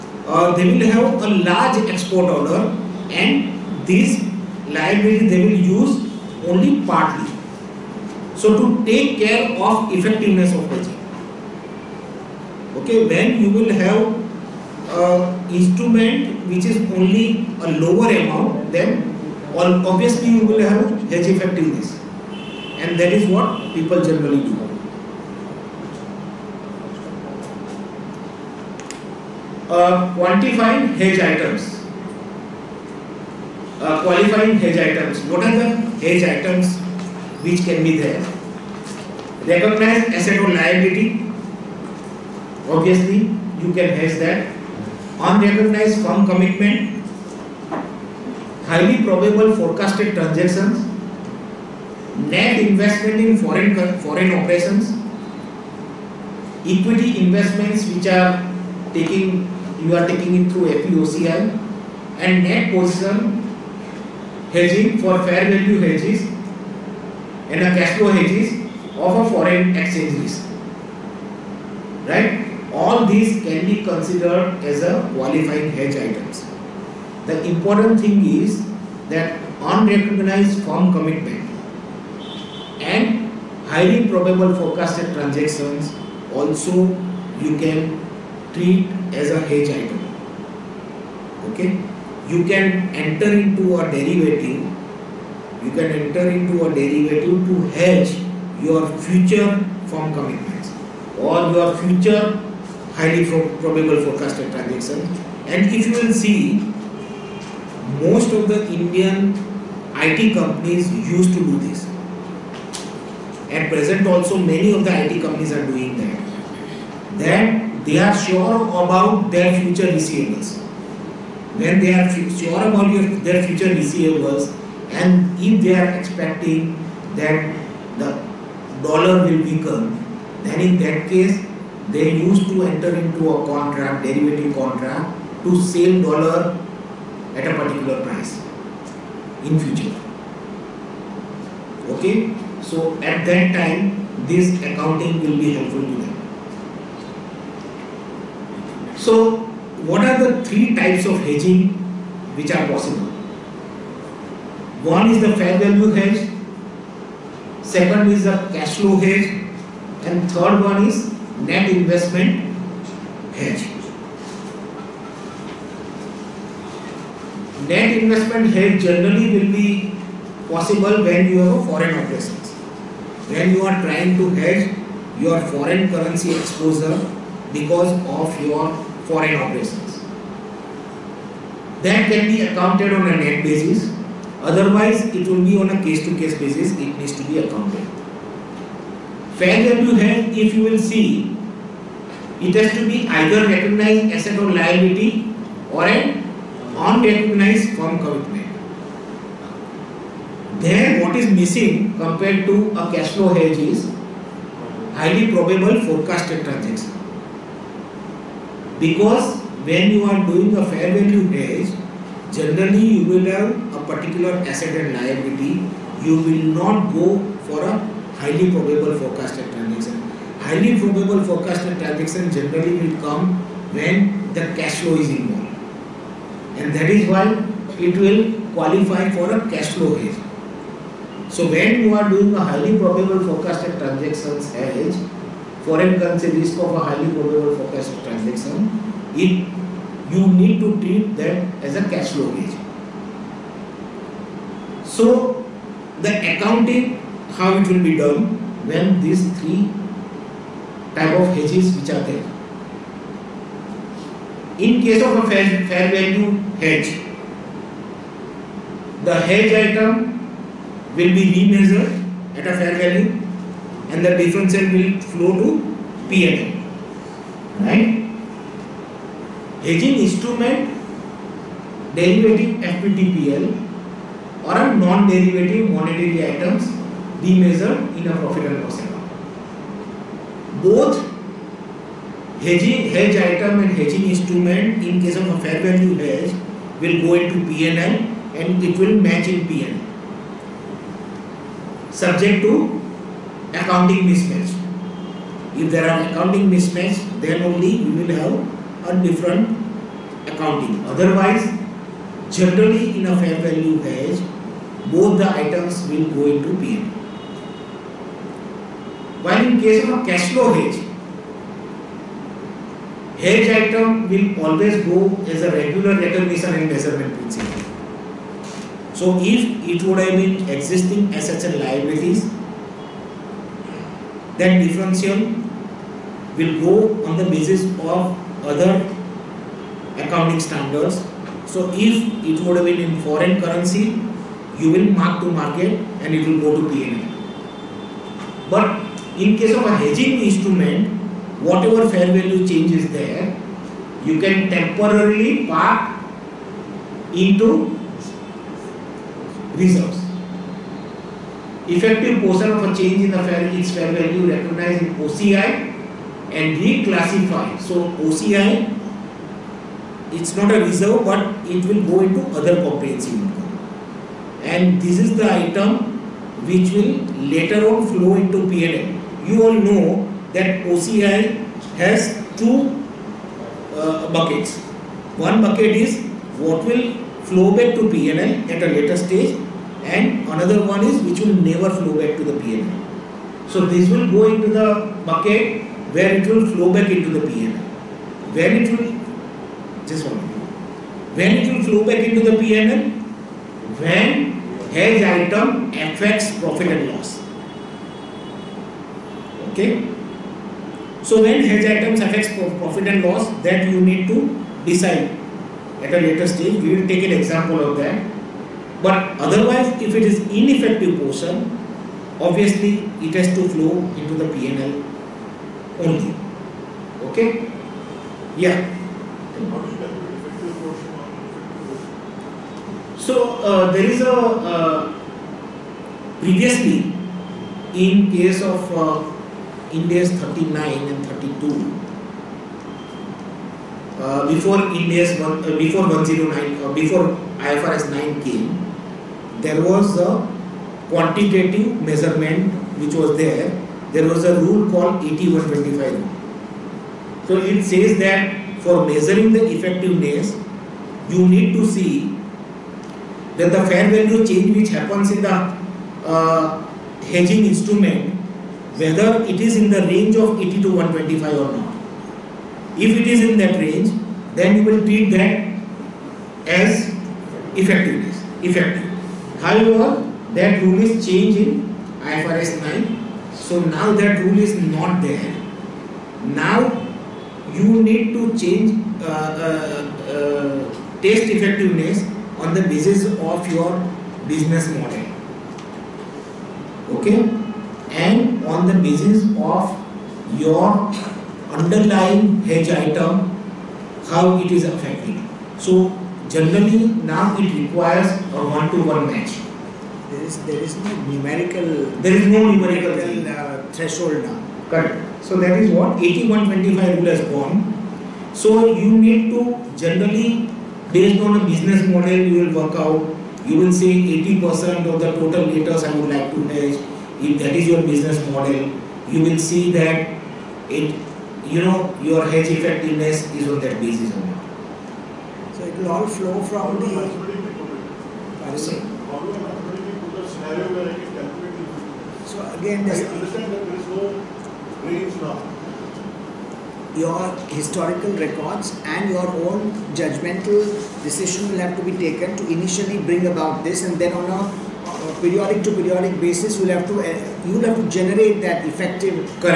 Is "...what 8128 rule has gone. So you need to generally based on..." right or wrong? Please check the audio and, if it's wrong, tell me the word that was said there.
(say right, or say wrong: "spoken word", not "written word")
wrong: "8125", not "8128".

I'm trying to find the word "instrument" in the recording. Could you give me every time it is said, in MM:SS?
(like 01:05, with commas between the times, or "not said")
00:15, 04:30, 04:44, 05:40, 07:37.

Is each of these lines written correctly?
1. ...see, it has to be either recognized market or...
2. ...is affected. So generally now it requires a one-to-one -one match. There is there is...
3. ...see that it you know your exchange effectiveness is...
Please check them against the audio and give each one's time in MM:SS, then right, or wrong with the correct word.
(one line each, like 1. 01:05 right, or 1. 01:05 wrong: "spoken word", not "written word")
1. 03:10 wrong: "asset", not "market"
2. 08:14 right
3. 08:39 wrong: "hedge", not "exchange".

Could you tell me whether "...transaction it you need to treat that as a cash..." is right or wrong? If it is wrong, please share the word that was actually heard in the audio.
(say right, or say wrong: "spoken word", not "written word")
right.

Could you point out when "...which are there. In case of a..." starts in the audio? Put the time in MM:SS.
04:11.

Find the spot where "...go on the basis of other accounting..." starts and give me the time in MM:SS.
05:26.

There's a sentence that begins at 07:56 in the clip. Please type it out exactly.
Now you need to change uh, uh, uh, taste effectiveness on the basis of your business model.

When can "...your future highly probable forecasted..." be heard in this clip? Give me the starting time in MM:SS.
01:41.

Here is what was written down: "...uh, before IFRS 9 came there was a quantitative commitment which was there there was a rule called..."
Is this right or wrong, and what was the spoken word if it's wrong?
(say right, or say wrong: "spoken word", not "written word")
wrong: "measurement", not "commitment".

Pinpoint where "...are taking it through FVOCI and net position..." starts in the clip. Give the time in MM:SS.
00:59.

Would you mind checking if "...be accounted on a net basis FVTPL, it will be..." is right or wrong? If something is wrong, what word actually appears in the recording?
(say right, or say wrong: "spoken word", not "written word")
wrong: "Otherwise", not "FVTPL".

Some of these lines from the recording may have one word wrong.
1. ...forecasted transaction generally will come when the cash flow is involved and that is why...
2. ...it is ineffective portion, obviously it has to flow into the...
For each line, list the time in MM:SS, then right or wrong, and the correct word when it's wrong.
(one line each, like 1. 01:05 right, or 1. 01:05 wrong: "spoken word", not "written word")
1. 03:41 right
2. 06:49 right.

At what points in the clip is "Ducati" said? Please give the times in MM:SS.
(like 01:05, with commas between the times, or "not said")
not said.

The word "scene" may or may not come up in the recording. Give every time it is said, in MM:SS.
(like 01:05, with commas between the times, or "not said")
not said.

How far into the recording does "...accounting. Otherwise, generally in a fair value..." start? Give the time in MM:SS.
05:00.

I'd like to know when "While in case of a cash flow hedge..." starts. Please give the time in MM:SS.
05:09.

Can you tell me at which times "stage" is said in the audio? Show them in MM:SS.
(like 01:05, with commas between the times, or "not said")
06:18, 06:46.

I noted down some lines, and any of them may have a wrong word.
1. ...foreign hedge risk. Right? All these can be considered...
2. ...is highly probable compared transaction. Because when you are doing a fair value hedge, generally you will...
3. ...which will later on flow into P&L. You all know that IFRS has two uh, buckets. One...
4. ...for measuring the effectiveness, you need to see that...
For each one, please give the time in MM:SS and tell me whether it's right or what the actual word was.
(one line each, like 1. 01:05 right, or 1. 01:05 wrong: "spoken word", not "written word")
1. 01:09 wrong: "exchange", not "hedge"
2. 03:23 wrong: "forecasted", not "compared"
3. 06:06 wrong: "OCI", not "IFRS"
4. 07:28 right.